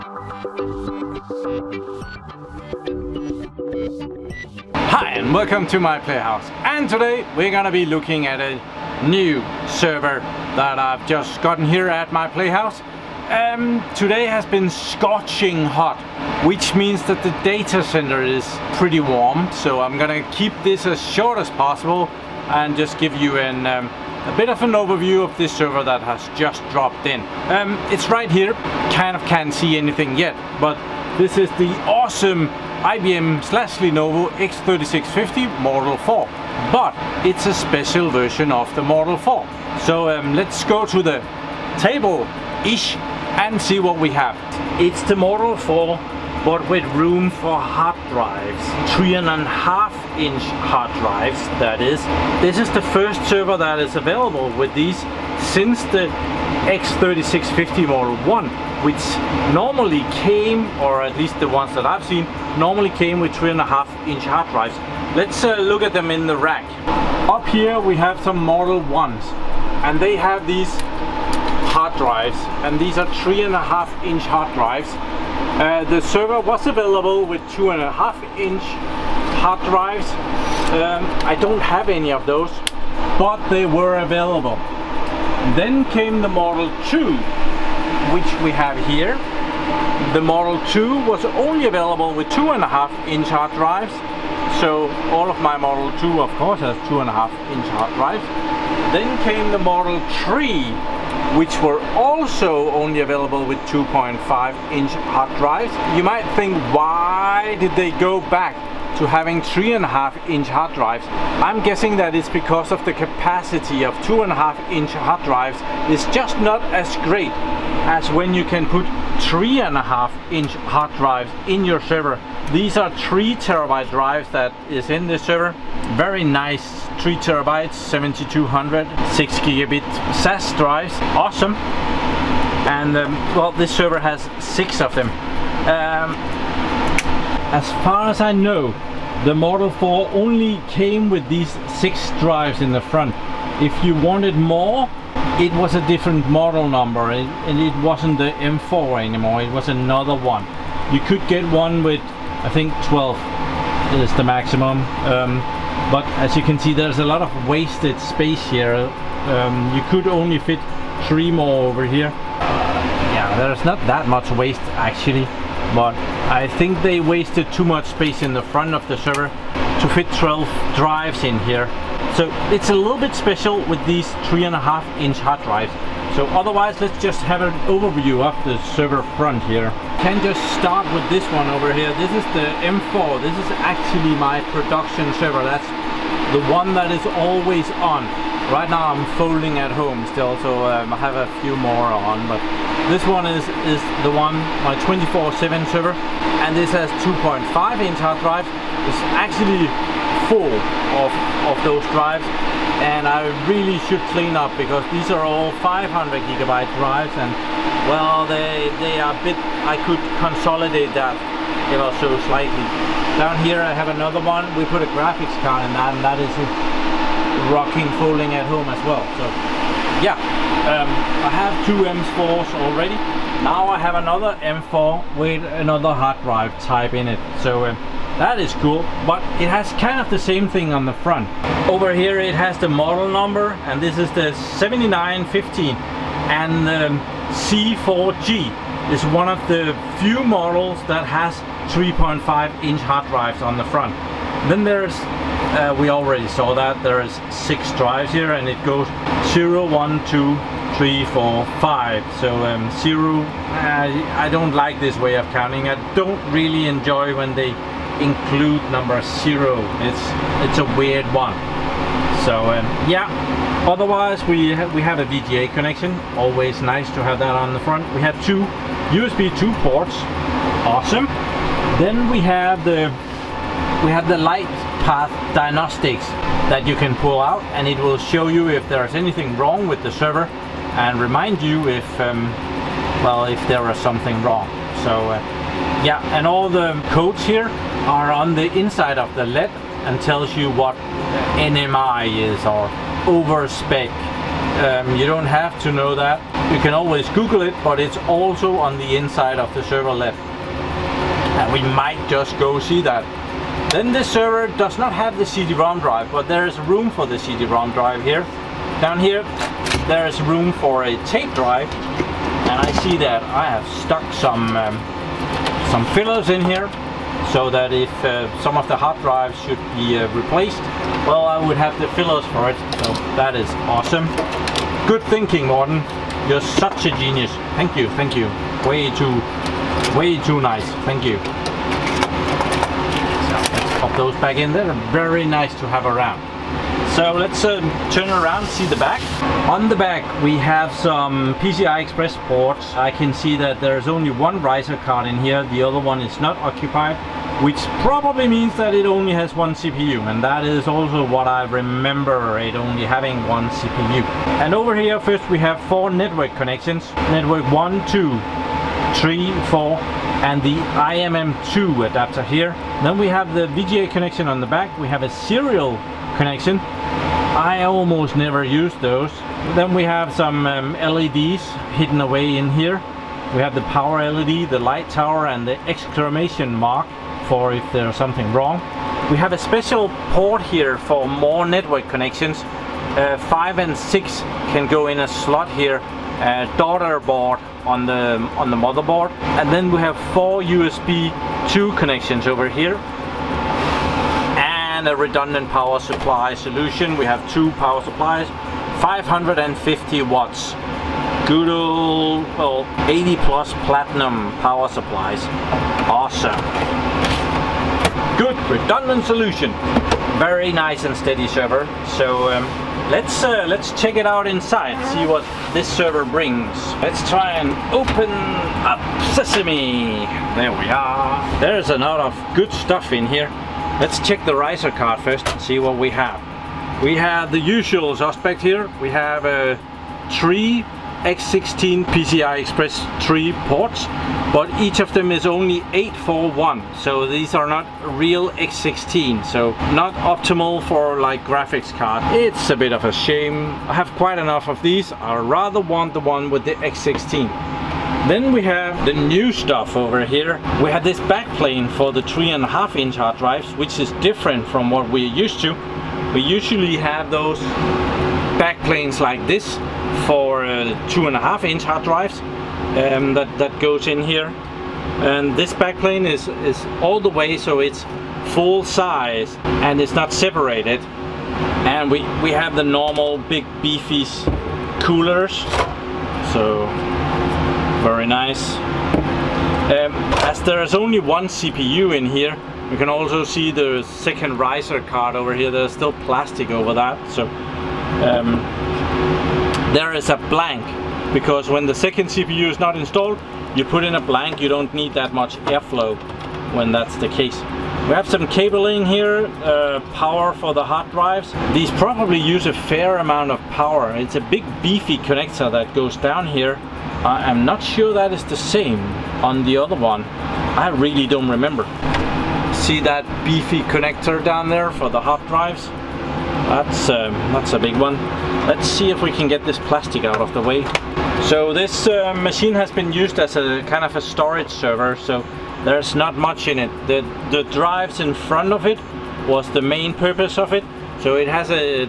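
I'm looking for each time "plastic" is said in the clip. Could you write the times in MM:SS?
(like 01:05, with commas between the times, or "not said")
08:06, 08:39.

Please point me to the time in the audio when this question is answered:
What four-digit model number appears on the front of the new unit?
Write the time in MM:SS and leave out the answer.
03:54.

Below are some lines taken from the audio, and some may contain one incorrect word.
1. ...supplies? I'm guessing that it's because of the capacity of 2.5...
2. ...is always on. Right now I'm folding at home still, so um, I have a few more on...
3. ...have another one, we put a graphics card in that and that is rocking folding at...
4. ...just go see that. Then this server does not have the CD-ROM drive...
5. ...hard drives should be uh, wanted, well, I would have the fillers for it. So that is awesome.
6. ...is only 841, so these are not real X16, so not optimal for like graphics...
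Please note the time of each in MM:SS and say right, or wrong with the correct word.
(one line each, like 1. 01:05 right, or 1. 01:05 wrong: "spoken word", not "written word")
1. 01:50 wrong: "drives", not "supplies"
2. 03:06 right
3. 03:33 right
4. 05:02 right
5. 05:18 wrong: "replaced", not "wanted"
6. 07:15 right.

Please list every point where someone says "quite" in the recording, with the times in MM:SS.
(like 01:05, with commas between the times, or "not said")
07:23.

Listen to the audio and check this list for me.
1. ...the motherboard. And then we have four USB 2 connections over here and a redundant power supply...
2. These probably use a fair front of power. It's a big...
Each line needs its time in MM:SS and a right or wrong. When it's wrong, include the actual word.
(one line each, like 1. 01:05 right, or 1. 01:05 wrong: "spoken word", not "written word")
1. 06:28 right
2. 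08:21 wrong: "amount", not "front".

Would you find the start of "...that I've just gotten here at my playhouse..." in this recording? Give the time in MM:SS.
00:10.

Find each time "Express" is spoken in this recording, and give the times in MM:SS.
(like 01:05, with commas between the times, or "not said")
05:41, 07:12.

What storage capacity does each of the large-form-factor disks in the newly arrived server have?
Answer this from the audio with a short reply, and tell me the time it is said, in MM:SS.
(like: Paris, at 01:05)
3 terabytes, at 02:02.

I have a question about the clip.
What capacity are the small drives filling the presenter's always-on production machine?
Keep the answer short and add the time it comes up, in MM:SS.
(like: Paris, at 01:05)
500 gigabyte, at 03:25.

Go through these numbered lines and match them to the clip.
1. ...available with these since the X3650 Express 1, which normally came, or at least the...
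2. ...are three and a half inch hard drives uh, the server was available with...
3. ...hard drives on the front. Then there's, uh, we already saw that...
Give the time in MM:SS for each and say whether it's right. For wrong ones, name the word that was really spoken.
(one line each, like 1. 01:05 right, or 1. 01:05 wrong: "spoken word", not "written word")
1. 00:53 wrong: "Model", not "Express"
2. 01:12 right
3. 04:02 right.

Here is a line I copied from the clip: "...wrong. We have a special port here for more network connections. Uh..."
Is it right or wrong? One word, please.
right.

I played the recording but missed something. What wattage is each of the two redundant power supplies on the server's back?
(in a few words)
550 watts.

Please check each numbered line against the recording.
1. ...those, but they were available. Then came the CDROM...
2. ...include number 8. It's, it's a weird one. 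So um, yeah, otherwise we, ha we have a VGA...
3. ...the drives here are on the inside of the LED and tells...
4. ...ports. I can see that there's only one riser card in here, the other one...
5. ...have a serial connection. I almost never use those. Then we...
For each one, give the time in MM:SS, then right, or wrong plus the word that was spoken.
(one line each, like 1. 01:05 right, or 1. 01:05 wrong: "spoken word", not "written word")
1. 01:22 wrong: "Model", not "CDROM"
2. 04:18 wrong: "0", not "8"
3. 04:46 wrong: "codes", not "drives"
4. 05:42 right
5. 06:04 right.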